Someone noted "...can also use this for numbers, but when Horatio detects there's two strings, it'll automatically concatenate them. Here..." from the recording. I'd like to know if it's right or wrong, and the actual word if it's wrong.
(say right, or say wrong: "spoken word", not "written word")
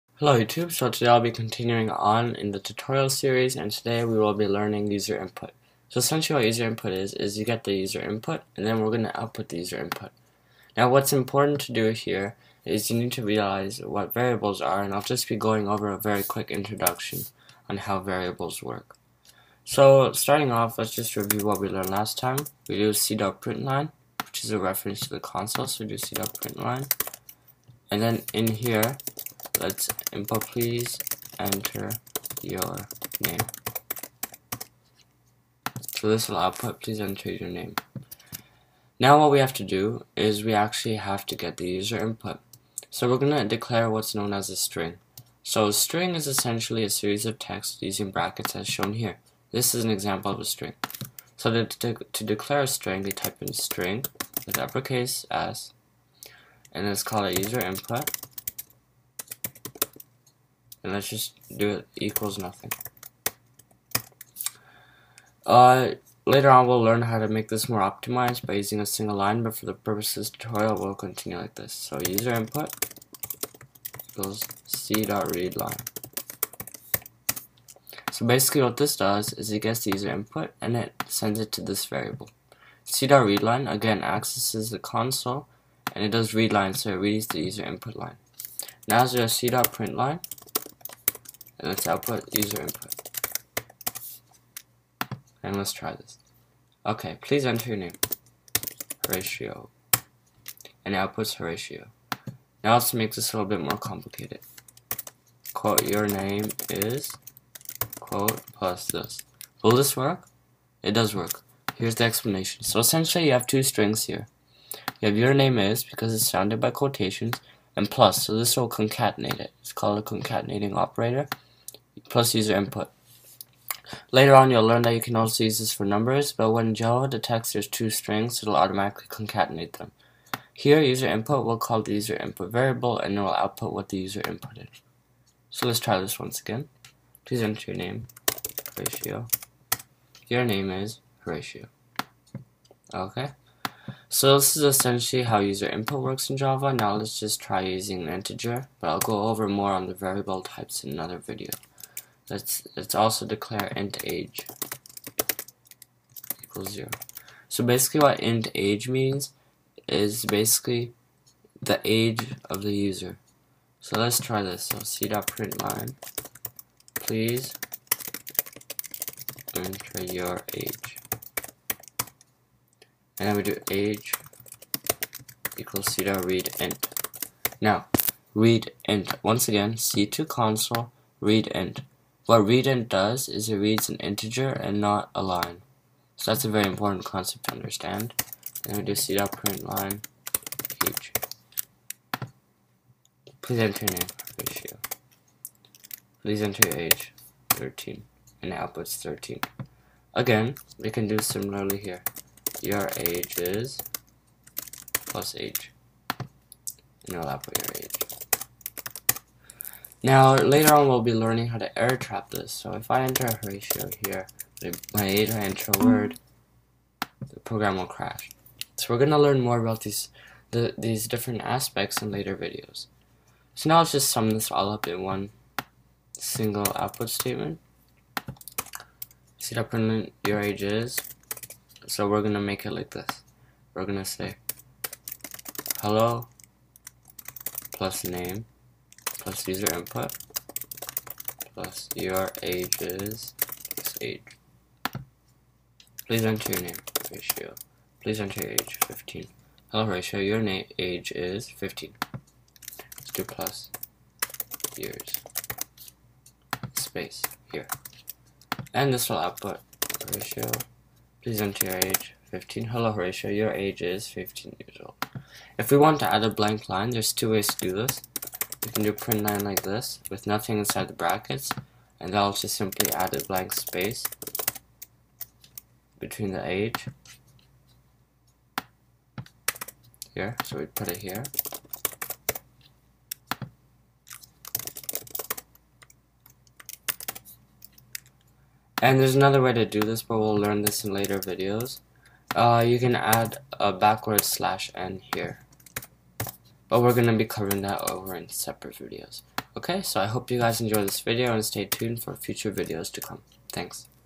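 wrong: "Java", not "Horatio".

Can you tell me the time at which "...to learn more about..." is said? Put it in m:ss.
3:39.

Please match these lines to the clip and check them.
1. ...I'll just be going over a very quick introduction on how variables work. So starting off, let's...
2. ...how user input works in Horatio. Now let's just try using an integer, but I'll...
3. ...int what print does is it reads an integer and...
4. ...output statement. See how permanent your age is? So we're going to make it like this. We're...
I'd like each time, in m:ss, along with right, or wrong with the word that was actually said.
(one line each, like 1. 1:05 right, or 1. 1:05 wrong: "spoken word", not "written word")
1. 0:14 right
2. 2:25 wrong: "Java", not "Horatio"
3. 3:01 wrong: "readint", not "print"
4. 3:46 right.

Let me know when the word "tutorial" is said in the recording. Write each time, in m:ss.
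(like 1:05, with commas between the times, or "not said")
0:02, 1:10.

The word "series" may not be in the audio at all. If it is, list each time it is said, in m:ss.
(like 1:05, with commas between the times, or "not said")
0:03, 0:46.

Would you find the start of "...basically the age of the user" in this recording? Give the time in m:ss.
2:40.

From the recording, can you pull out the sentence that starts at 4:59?
Okay, so I hope you guys enjoy this video and stay tuned for future videos to come.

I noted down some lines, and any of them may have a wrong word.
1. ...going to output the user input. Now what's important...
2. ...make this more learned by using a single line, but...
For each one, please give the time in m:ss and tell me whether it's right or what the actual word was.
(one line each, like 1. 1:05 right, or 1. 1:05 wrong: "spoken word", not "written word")
1. 0:08 right
2. 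1:07 wrong: "optimized", not "learned".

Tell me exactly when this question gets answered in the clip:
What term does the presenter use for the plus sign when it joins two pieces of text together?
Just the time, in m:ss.
2:00.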